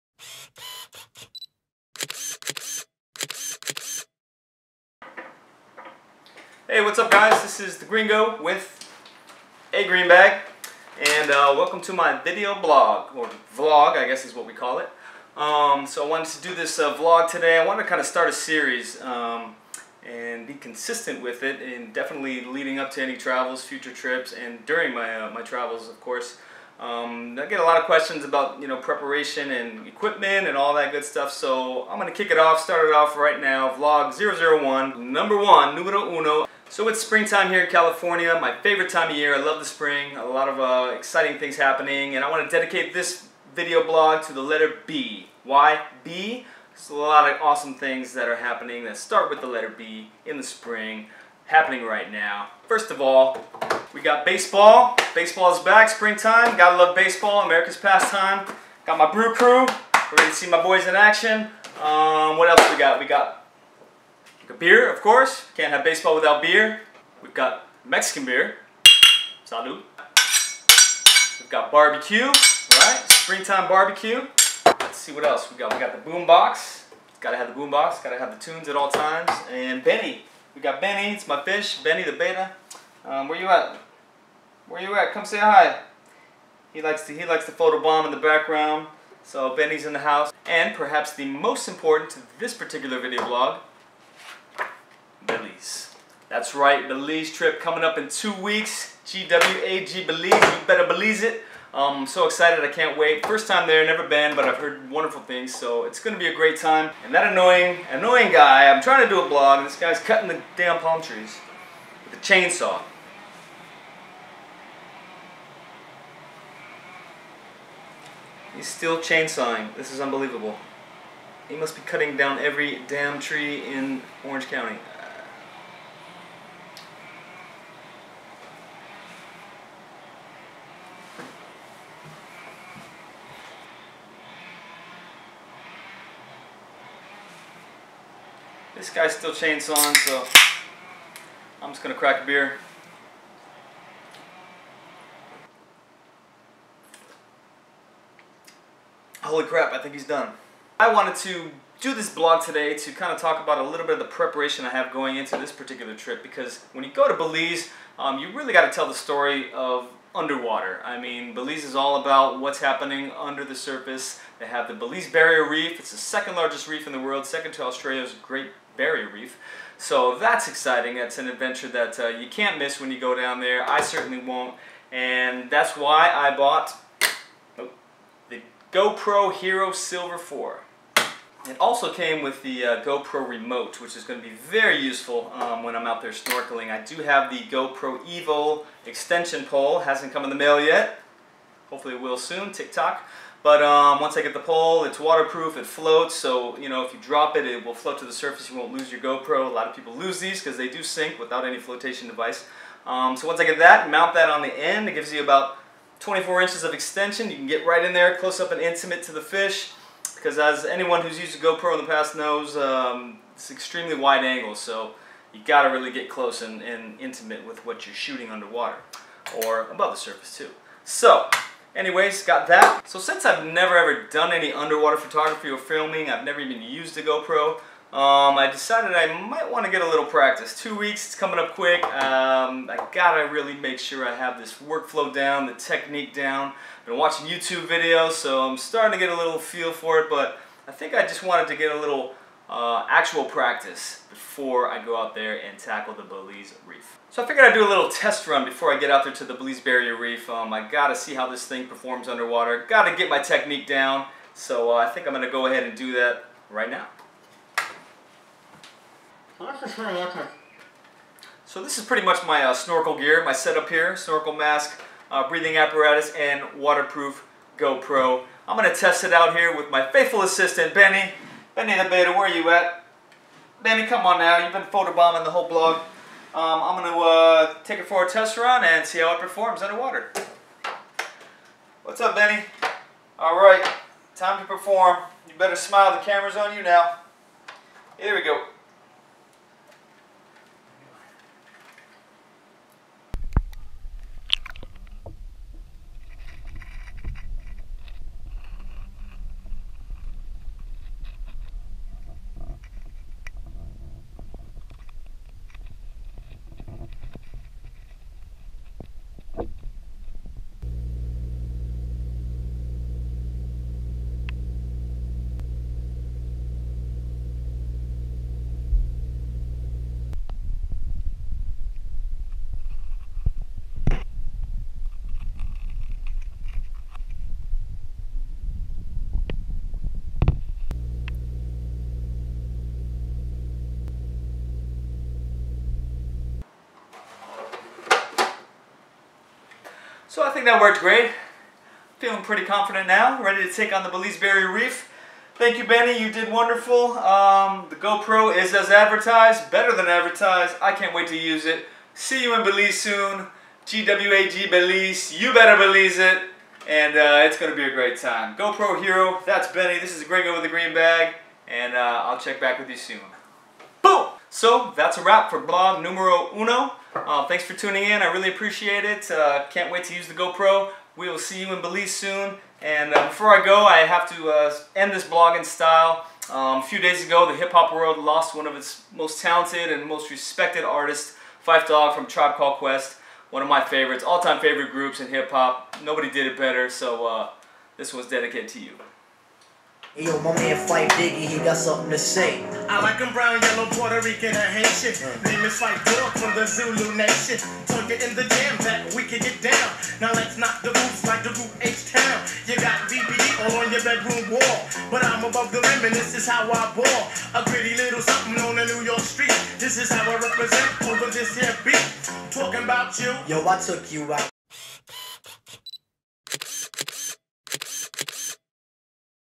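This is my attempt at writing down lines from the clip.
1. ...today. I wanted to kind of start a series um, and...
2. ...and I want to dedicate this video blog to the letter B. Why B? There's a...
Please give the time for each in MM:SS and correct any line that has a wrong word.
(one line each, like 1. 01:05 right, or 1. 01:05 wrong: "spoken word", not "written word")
1. 00:17 right
2. 00:42 right.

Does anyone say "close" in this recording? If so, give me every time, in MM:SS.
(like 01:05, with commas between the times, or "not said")
03:28, 03:36.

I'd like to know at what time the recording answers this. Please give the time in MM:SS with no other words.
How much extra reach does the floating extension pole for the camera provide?
03:26.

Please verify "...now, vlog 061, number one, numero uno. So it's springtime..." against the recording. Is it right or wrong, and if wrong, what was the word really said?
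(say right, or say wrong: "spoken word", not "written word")
wrong: "001", not "061".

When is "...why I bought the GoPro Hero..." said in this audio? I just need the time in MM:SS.
02:55.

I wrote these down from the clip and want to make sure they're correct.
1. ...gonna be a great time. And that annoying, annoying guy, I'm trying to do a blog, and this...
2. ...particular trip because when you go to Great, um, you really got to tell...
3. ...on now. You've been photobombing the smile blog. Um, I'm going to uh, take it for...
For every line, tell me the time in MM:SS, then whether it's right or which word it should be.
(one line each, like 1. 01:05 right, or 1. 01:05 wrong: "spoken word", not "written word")
1. 01:45 right
2. 02:35 wrong: "Belize", not "Great"
3. 04:34 wrong: "whole", not "smile".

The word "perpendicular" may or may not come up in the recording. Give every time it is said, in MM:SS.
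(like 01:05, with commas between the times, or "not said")
not said.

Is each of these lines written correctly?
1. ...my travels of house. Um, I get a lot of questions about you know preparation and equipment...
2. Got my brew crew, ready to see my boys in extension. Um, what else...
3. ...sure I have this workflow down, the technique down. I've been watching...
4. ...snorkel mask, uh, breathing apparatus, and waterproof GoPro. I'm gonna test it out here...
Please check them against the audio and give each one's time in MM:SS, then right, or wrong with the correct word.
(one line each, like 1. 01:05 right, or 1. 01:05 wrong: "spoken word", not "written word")
1. 00:25 wrong: "course", not "house"
2. 00:58 wrong: "action", not "extension"
3. 03:53 right
4. 04:23 right.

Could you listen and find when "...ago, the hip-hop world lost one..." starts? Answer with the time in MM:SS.
06:17.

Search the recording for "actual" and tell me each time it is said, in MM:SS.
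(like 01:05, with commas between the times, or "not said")
04:02.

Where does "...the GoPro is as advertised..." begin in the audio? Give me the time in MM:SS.
05:47.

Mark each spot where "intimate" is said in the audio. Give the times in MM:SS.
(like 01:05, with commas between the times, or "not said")
03:28, 03:37.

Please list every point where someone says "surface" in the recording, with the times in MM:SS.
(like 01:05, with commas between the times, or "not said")
02:43, 03:18, 03:39.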